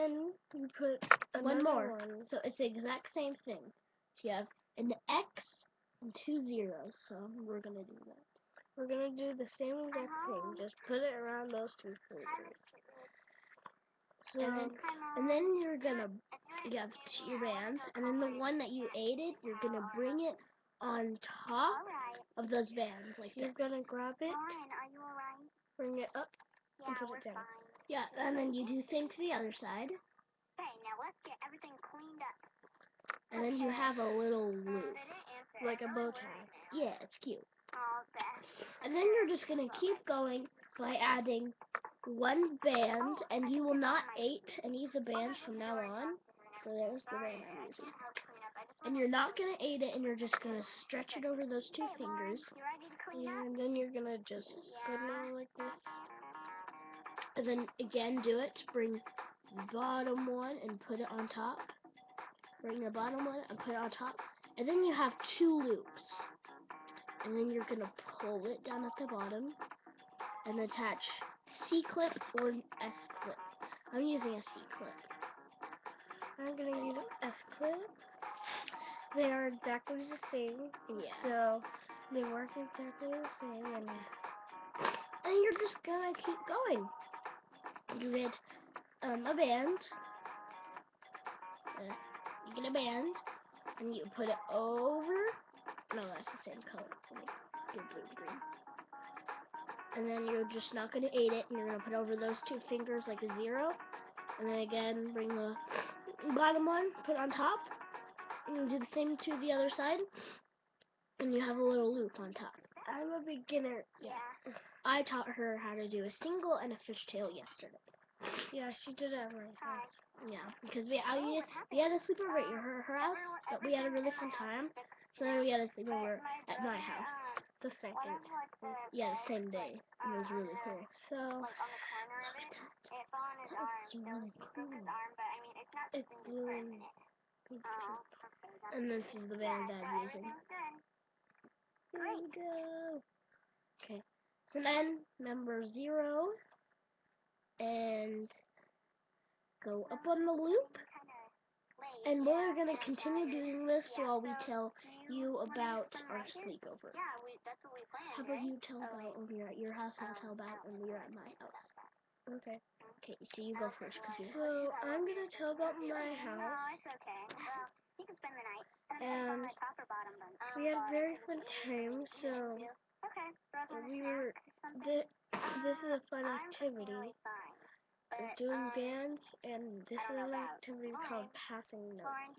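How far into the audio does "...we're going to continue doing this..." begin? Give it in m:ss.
2:32.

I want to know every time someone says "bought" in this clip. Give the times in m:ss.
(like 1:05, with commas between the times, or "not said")
not said.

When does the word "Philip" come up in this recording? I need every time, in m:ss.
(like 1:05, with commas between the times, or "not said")
not said.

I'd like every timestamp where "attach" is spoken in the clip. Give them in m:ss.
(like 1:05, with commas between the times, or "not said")
1:10.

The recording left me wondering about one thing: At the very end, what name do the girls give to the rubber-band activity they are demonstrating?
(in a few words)
Passing.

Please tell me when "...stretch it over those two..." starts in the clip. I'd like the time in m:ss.
0:50.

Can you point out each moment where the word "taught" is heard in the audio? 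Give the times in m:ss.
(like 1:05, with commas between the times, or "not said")
1:55.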